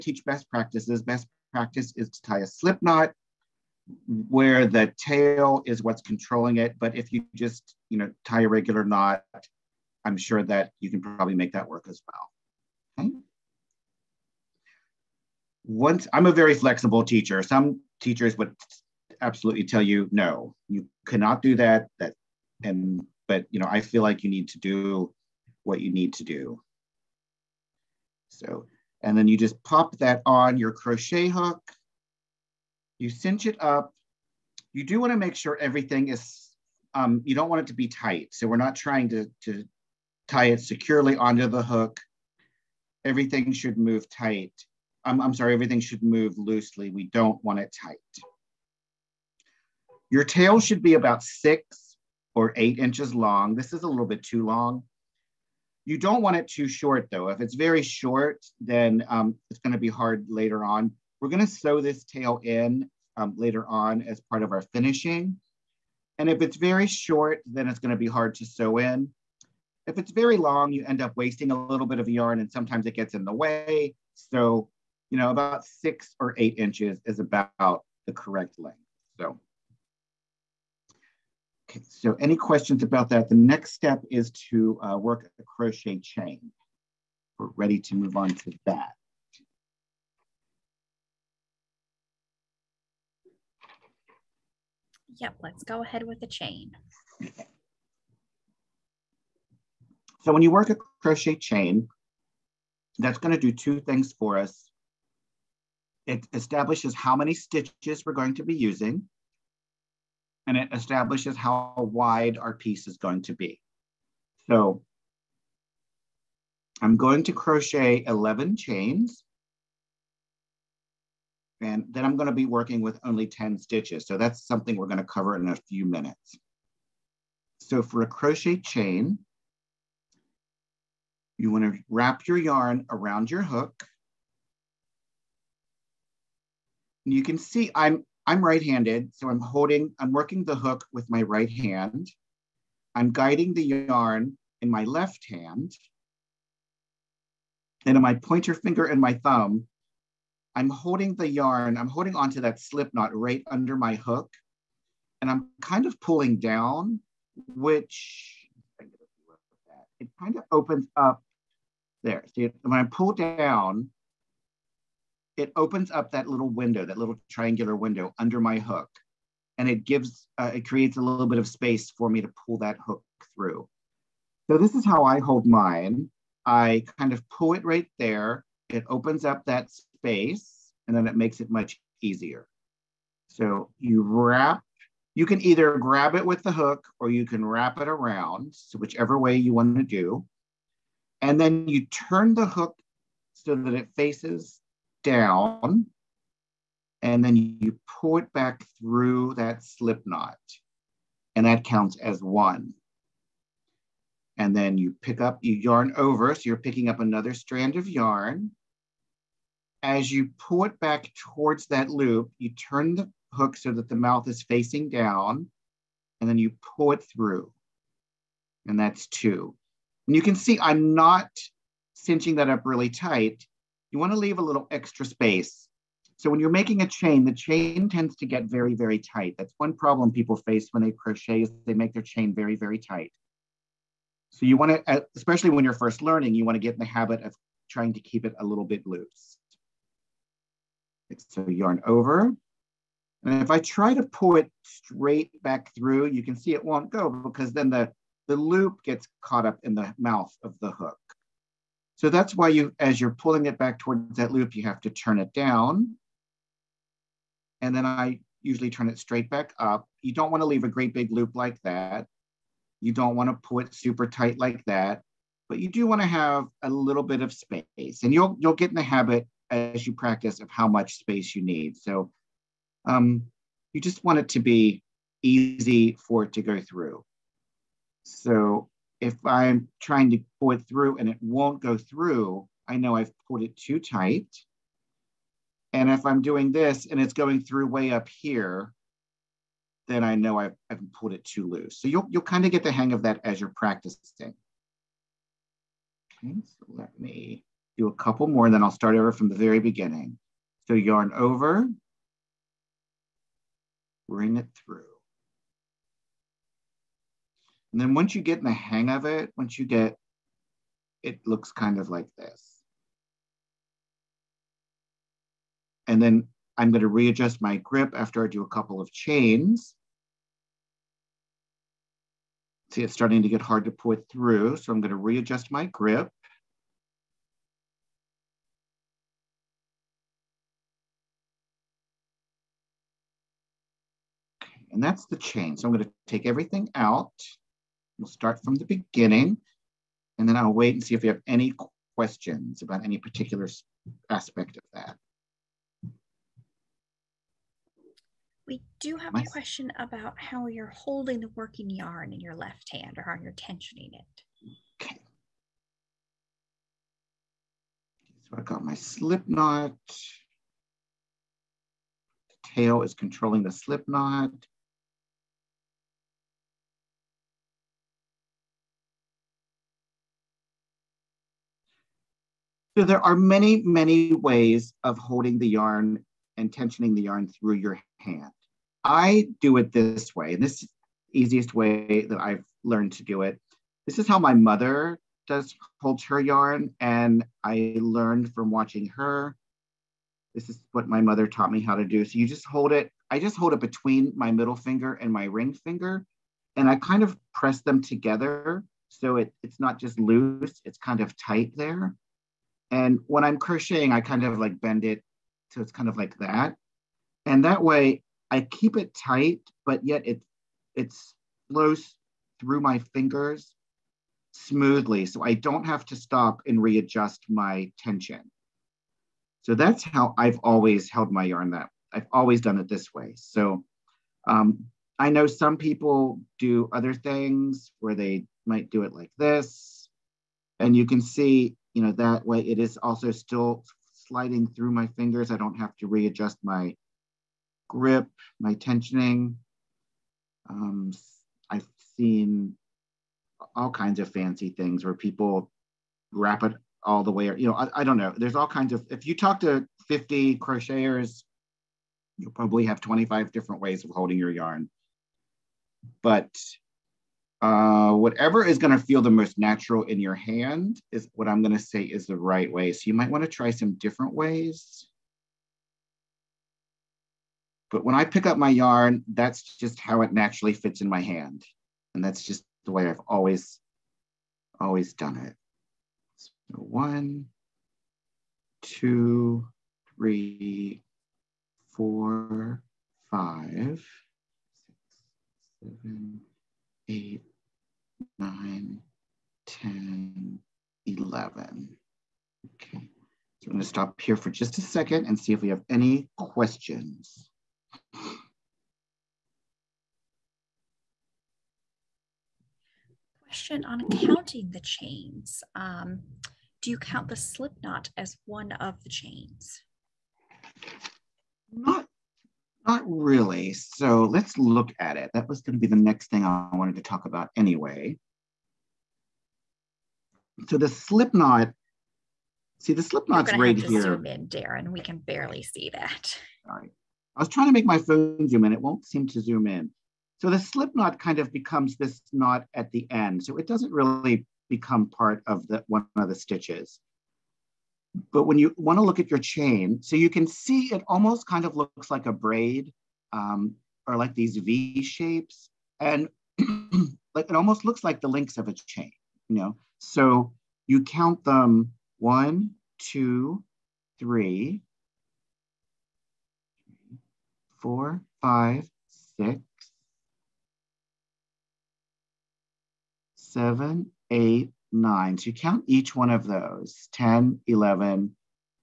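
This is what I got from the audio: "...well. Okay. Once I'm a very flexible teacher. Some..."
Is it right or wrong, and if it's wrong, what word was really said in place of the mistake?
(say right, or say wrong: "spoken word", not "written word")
right.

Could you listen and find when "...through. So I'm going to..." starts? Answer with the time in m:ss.
5:24.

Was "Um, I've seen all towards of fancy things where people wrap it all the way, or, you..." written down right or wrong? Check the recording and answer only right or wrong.
wrong.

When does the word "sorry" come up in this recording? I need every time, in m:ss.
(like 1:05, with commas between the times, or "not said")
0:45, 8:46.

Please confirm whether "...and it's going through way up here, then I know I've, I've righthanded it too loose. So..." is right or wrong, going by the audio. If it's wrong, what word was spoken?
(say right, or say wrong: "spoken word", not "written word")
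wrong: "pulled", not "righthanded".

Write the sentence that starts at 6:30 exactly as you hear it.
This is what my mother taught me how to do.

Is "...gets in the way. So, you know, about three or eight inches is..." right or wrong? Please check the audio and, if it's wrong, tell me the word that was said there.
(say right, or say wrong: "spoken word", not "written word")
wrong: "six", not "three".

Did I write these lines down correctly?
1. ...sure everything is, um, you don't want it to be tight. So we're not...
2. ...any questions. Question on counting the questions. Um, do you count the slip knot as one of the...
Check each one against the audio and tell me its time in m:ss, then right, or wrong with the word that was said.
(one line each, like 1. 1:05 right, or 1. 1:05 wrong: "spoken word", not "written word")
1. 0:35 right
2. 8:15 wrong: "chains", not "questions".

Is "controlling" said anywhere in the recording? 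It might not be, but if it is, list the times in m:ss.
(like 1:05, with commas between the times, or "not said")
0:06, 6:02.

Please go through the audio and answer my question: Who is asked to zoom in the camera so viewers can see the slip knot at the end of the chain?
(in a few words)
Darrin.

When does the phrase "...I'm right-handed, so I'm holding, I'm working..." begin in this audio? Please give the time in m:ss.
2:18.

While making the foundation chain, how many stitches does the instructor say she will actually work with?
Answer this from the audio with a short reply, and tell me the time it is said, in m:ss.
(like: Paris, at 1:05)
10, at 2:03.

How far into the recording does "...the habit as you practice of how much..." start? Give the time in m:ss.
4:28.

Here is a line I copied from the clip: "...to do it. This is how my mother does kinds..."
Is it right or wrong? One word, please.
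wrong.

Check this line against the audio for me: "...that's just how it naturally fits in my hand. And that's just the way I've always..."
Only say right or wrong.
right.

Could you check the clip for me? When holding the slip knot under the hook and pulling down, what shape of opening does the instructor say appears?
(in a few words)
triangular window.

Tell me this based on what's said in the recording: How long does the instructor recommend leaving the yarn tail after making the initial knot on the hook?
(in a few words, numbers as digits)
6 or 8 inches.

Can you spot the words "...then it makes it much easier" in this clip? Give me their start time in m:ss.
3:00.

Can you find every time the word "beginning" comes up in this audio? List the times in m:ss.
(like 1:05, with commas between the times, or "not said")
4:59, 5:38.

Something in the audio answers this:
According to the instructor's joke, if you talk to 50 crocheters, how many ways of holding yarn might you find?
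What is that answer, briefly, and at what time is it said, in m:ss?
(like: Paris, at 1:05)
25, at 7:32.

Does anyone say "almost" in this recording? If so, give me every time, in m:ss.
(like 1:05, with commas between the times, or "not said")
9:00, 9:07.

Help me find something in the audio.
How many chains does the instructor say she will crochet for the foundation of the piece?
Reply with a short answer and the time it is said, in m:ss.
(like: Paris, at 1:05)
11, at 1:58.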